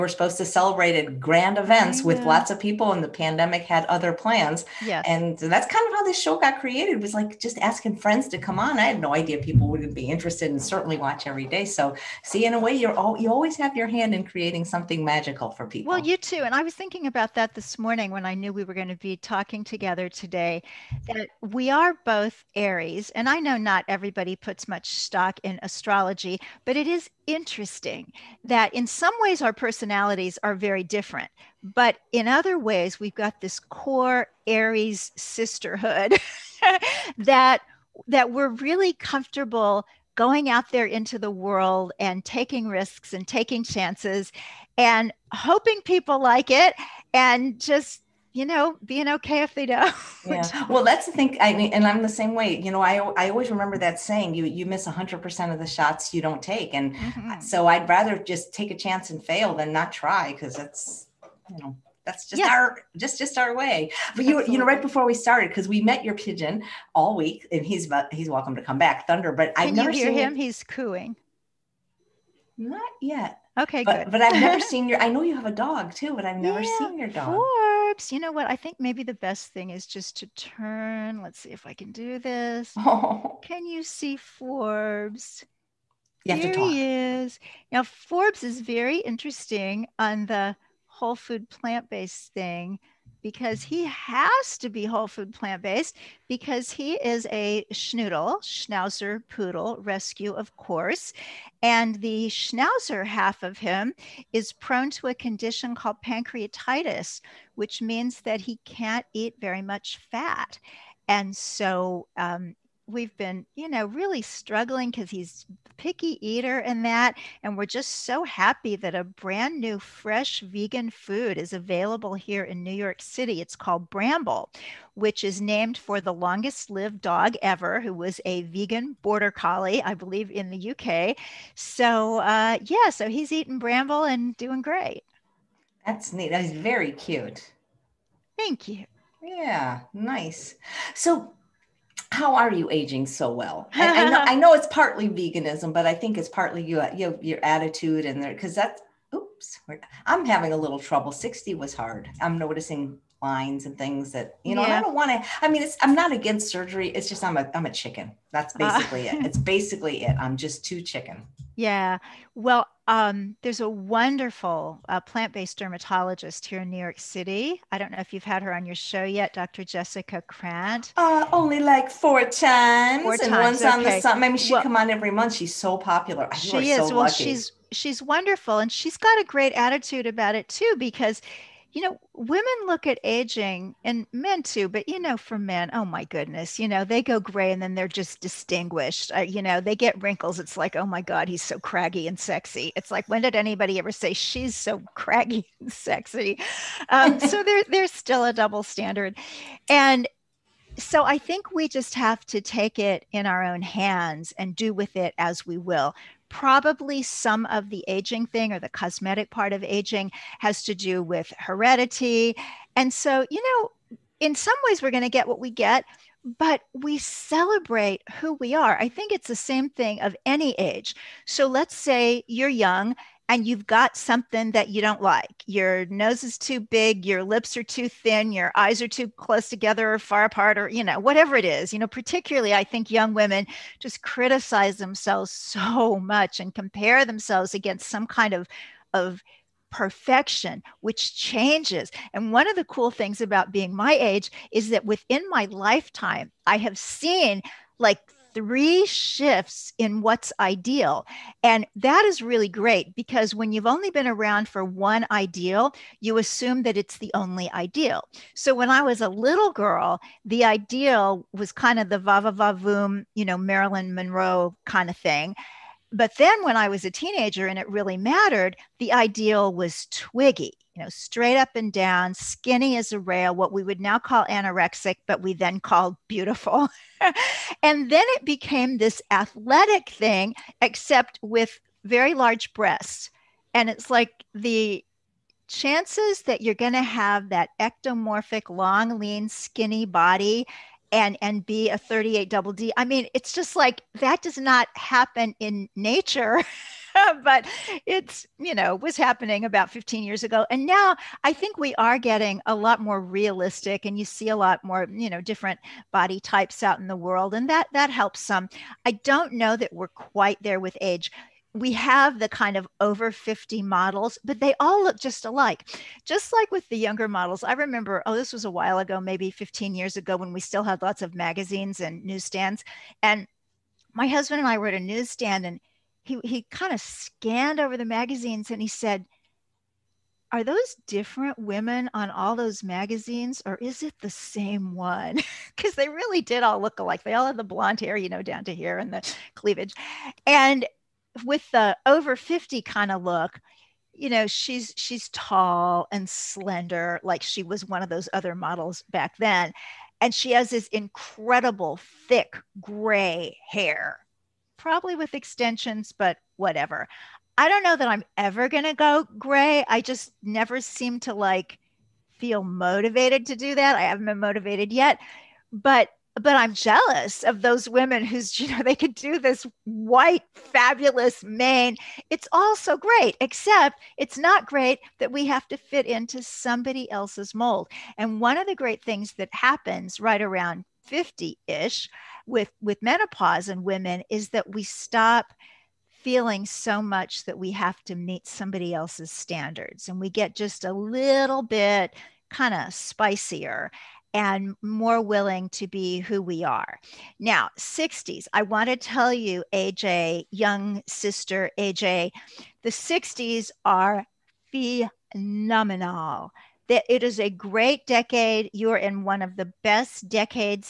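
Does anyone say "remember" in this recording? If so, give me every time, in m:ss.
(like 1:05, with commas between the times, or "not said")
0:53, 5:17.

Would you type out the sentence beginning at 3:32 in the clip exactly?
And so, you know, in some ways, we're going to get what we get, but we celebrate who we are.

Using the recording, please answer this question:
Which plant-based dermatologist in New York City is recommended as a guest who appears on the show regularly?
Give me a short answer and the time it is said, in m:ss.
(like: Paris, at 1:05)
Dr. Jessica Krant, at 2:49.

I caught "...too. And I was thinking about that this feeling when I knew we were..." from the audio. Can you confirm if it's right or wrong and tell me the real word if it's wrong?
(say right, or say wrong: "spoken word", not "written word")
wrong: "morning", not "feeling".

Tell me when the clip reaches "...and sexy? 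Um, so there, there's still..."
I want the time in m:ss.
3:15.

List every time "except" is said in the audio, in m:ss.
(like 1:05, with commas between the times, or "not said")
4:40, 6:13.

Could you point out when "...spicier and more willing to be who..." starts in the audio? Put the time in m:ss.
6:32.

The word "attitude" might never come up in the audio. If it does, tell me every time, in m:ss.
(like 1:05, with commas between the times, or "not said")
2:27, 2:59.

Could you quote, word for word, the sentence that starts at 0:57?
so I'd rather just take a chance and fail than not try because that's you know that's just yeah.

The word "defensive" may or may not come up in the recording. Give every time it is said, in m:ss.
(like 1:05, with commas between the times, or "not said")
not said.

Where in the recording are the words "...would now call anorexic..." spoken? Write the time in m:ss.
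4:33.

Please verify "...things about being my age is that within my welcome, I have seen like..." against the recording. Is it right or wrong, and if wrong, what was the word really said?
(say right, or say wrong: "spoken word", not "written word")
wrong: "lifetime", not "welcome".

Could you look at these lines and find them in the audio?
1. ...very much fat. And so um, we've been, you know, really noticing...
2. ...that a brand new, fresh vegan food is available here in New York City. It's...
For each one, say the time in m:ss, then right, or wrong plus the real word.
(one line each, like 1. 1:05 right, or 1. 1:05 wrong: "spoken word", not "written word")
1. 1:49 wrong: "struggling", not "noticing"
2. 1:58 right.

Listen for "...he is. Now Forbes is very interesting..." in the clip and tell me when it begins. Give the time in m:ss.
1:26.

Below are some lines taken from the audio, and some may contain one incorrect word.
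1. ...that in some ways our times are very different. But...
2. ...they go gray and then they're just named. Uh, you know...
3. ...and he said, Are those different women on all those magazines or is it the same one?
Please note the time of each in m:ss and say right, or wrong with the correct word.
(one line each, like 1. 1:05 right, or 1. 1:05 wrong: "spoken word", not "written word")
1. 0:28 wrong: "personalities", not "times"
2. 3:06 wrong: "distinguished", not "named"
3. 5:28 right.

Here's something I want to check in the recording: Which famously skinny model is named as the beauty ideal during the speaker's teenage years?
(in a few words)
Twiggy.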